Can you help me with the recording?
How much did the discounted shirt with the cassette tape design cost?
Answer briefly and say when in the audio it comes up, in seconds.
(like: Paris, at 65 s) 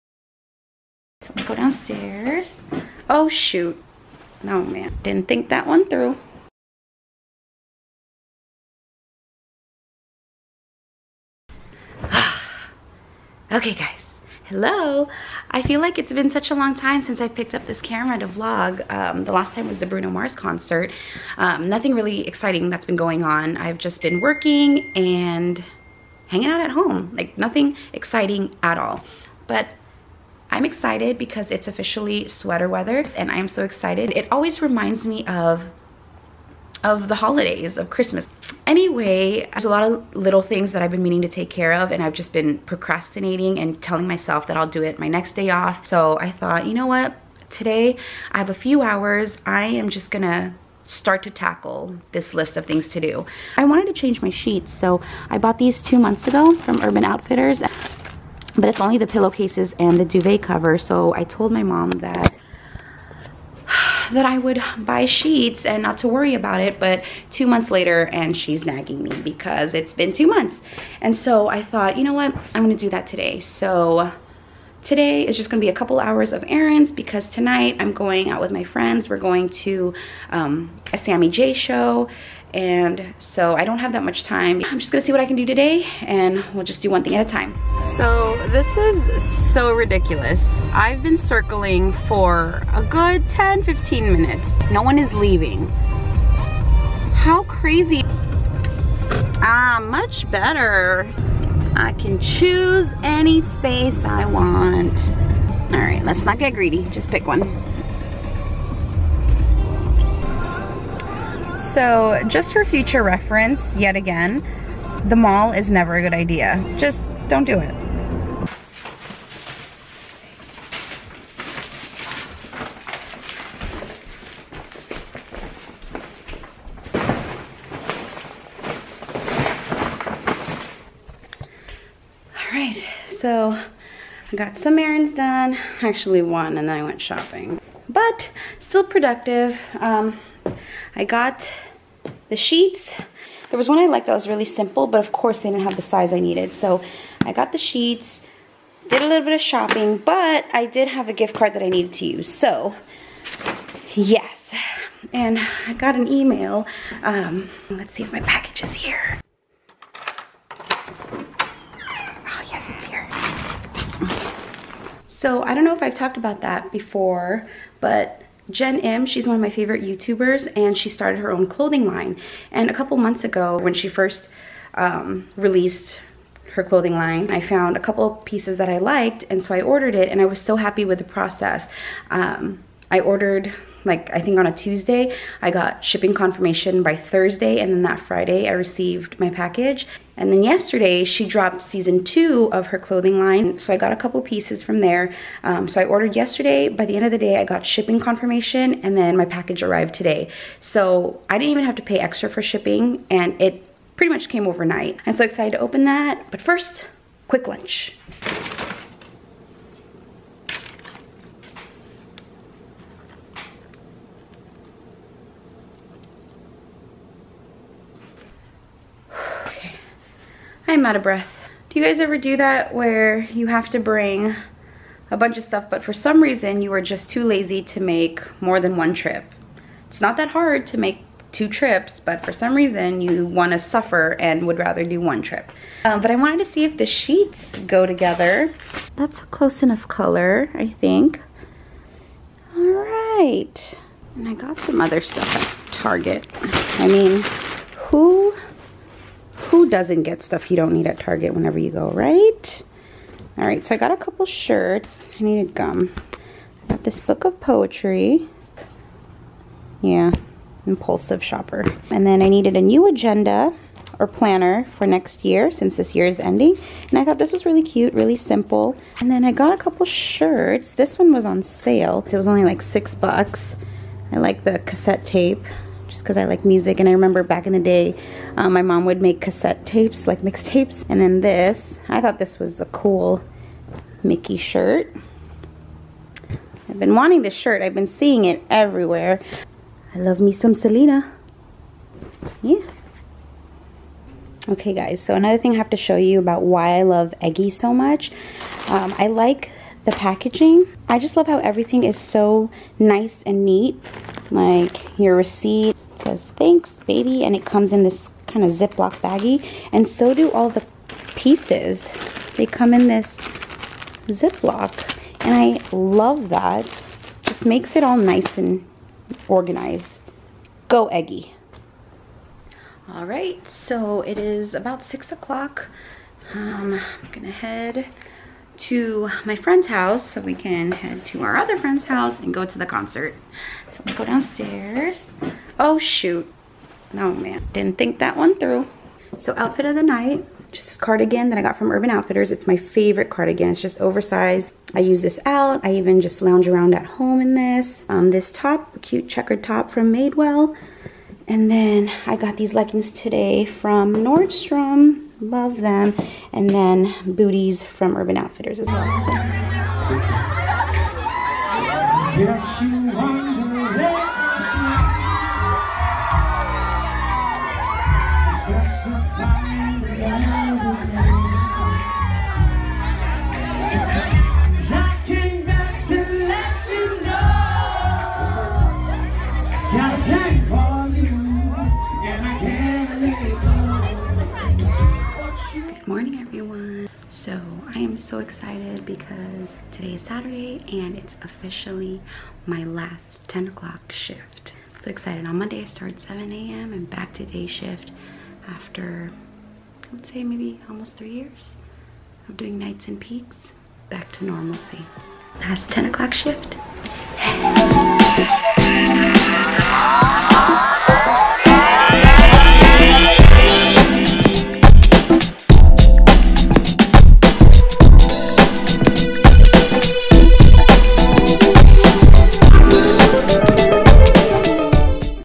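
6 dollars, at 272 s.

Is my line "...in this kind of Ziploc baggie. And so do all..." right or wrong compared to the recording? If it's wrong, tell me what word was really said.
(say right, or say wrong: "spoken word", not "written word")
right.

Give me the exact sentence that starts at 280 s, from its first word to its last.
And then this, I thought this was a cool Mickey shirt.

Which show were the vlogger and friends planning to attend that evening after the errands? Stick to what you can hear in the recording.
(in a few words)
Sammy J show.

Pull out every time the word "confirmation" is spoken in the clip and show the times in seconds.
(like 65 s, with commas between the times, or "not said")
186 s, 197 s.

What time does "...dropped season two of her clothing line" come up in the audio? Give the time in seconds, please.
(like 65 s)
191 s.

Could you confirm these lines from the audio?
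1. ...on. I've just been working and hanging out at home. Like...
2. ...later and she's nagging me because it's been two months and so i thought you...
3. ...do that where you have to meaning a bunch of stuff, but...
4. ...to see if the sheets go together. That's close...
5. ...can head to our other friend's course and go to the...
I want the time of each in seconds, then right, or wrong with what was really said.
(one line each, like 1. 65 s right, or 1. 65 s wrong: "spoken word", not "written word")
1. 23 s right
2. 67 s right
3. 222 s wrong: "bring", not "meaning"
4. 236 s right
5. 330 s wrong: "house", not "course".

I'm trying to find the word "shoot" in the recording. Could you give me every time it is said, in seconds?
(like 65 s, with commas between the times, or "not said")
3 s, 335 s.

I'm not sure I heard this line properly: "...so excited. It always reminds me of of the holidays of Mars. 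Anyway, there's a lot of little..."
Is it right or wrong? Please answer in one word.
wrong.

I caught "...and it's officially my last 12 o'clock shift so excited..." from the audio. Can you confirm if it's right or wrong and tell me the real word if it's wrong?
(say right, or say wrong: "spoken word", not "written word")
wrong: "10", not "12".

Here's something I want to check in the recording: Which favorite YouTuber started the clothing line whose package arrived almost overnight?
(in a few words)
Jenn Im.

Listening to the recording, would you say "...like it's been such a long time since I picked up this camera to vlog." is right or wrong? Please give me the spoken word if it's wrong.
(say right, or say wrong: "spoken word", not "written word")
right.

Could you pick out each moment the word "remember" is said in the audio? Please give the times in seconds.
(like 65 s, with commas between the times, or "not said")
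276 s.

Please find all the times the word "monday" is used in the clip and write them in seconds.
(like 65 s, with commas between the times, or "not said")
395 s.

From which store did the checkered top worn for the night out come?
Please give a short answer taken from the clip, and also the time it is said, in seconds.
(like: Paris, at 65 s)
Madewell, at 349 s.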